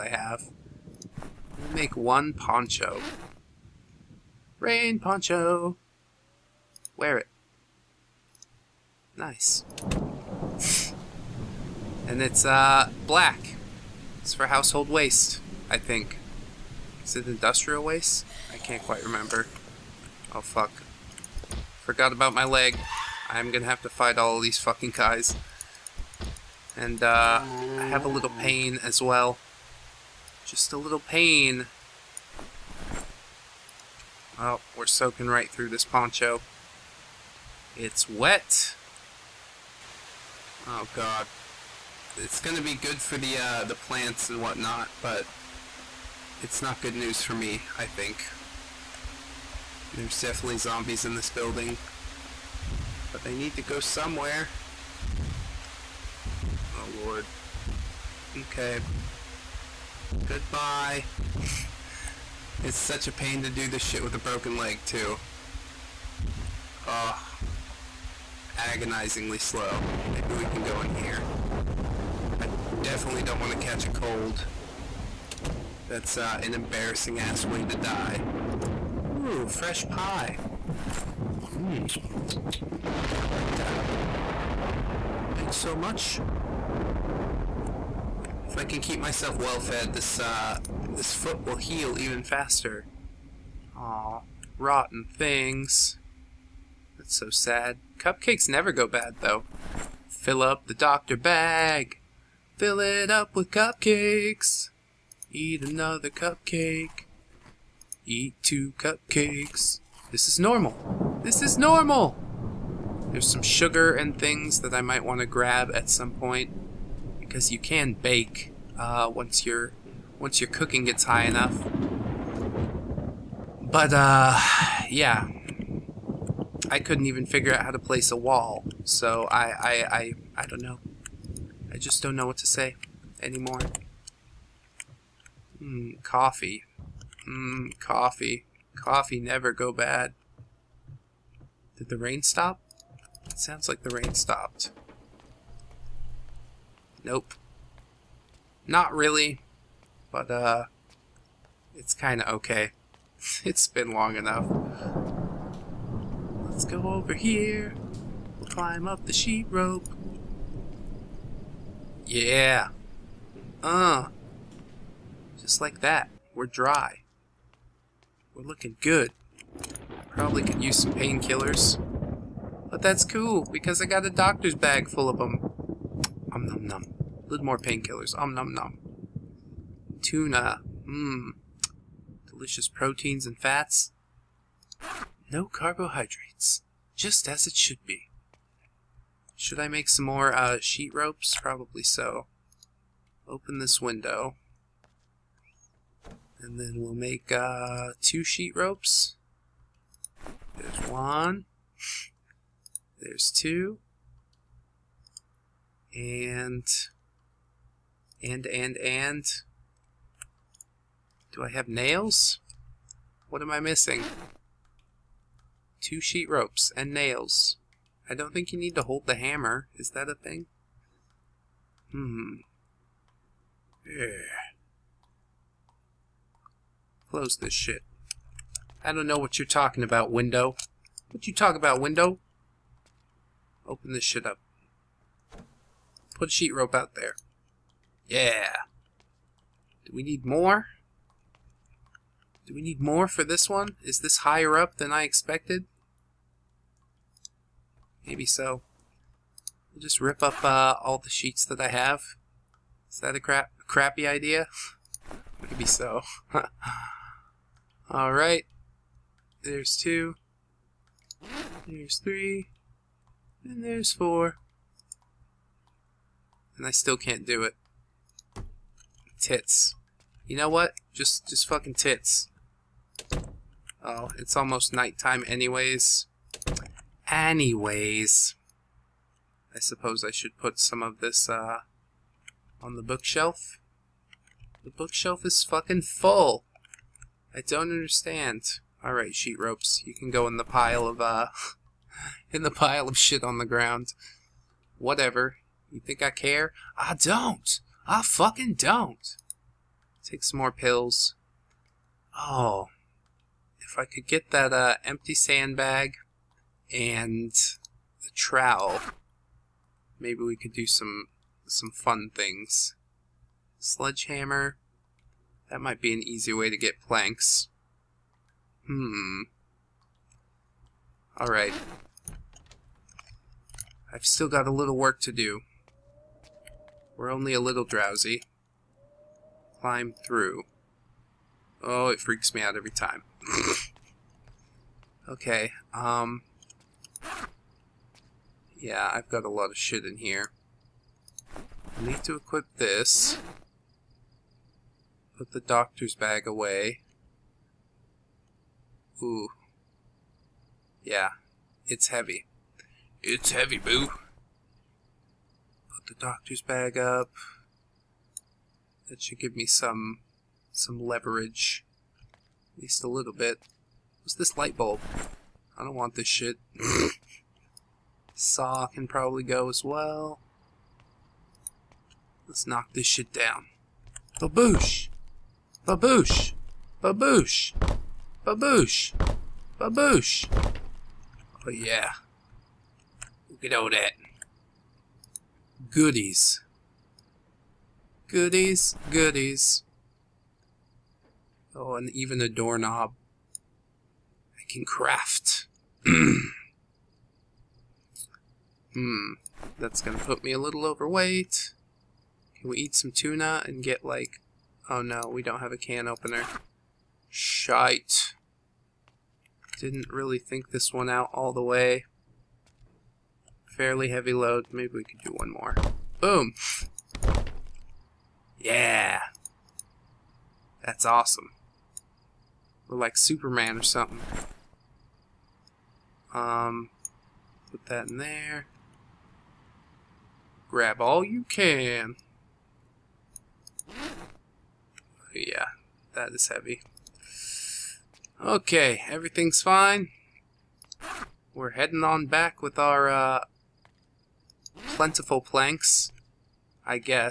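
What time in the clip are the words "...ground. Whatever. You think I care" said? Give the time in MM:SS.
04:53.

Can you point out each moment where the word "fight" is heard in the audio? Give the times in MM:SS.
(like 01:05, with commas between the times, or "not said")
00:23.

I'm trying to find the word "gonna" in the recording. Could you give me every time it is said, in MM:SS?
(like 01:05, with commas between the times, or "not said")
00:23, 00:42, 06:39.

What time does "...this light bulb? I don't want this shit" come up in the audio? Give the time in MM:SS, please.
06:04.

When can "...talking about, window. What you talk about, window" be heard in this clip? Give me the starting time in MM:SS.
03:49.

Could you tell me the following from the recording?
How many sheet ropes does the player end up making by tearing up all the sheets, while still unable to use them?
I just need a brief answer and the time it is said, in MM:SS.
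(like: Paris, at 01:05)
4, at 04:23.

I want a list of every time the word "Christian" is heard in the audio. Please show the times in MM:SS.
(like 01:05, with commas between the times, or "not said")
not said.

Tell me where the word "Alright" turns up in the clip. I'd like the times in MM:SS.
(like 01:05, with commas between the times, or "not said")
04:17, 04:48, 05:21.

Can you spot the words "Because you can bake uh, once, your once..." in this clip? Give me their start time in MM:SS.
01:57.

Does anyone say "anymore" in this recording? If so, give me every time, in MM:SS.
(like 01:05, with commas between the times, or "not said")
02:13.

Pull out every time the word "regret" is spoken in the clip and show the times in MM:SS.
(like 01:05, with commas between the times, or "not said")
not said.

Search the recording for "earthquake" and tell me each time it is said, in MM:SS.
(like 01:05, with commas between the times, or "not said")
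not said.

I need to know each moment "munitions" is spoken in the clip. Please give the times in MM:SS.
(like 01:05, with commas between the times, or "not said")
not said.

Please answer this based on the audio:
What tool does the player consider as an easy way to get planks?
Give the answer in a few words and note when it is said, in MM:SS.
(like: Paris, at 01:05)
Sledgehammer, at 05:13.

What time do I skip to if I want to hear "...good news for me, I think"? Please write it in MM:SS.
00:46.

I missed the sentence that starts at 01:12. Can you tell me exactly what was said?
I definitely don't want to catch a cold.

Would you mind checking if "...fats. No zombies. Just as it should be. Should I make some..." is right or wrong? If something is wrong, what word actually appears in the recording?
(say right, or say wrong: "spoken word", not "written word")
wrong: "carbohydrates", not "zombies".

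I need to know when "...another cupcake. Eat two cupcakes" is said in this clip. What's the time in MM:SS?
01:45.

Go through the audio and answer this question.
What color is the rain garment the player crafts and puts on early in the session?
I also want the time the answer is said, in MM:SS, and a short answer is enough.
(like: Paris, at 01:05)
Black, at 00:13.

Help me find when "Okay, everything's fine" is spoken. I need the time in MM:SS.
07:18.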